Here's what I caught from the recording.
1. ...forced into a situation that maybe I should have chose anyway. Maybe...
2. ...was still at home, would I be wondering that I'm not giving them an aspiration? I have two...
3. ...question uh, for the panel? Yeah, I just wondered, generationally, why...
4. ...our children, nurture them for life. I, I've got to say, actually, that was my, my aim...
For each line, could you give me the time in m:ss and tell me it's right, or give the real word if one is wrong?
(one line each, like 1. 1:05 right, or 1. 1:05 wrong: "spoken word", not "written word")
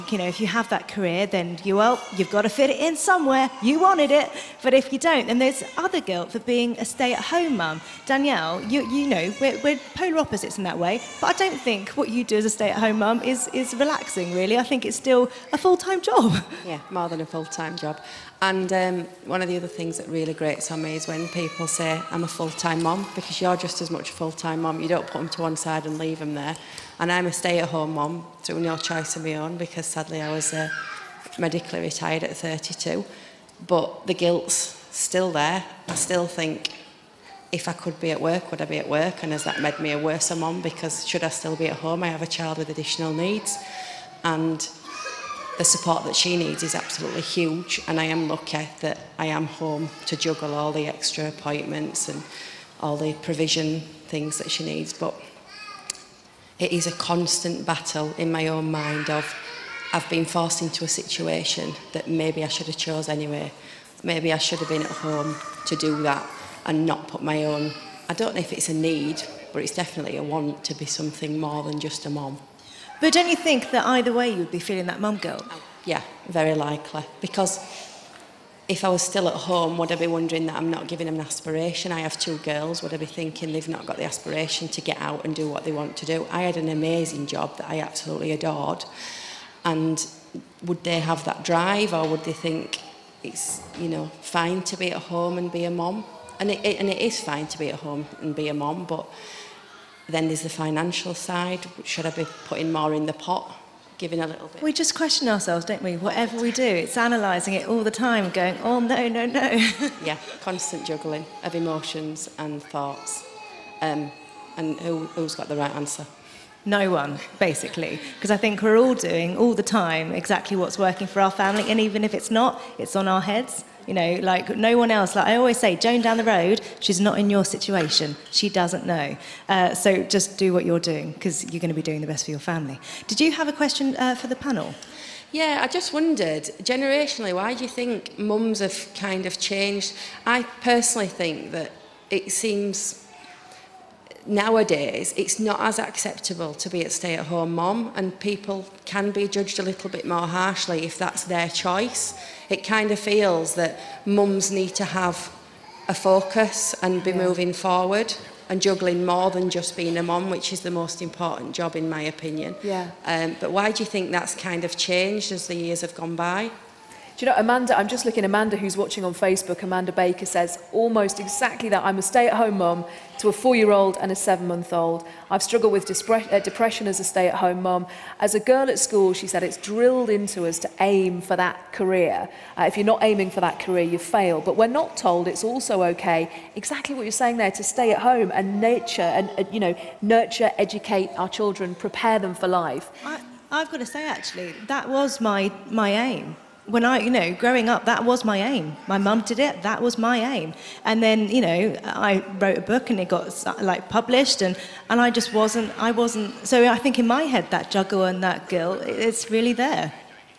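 1. 1:00 right
2. 1:18 right
3. 2:13 right
4. 3:11 wrong: "prepare", not "nurture".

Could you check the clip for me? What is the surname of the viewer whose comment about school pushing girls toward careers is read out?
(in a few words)
Baker.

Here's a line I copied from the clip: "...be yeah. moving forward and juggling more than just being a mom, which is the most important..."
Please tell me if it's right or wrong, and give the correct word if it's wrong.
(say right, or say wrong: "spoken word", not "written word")
right.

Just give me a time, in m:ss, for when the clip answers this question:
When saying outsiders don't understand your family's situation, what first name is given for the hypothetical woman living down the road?
2:05.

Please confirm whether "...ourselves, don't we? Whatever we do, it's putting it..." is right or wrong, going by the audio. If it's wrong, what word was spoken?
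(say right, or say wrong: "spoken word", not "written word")
wrong: "analysing", not "putting".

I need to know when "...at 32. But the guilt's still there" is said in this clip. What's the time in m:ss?
0:32.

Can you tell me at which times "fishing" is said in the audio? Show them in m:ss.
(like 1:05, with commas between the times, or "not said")
not said.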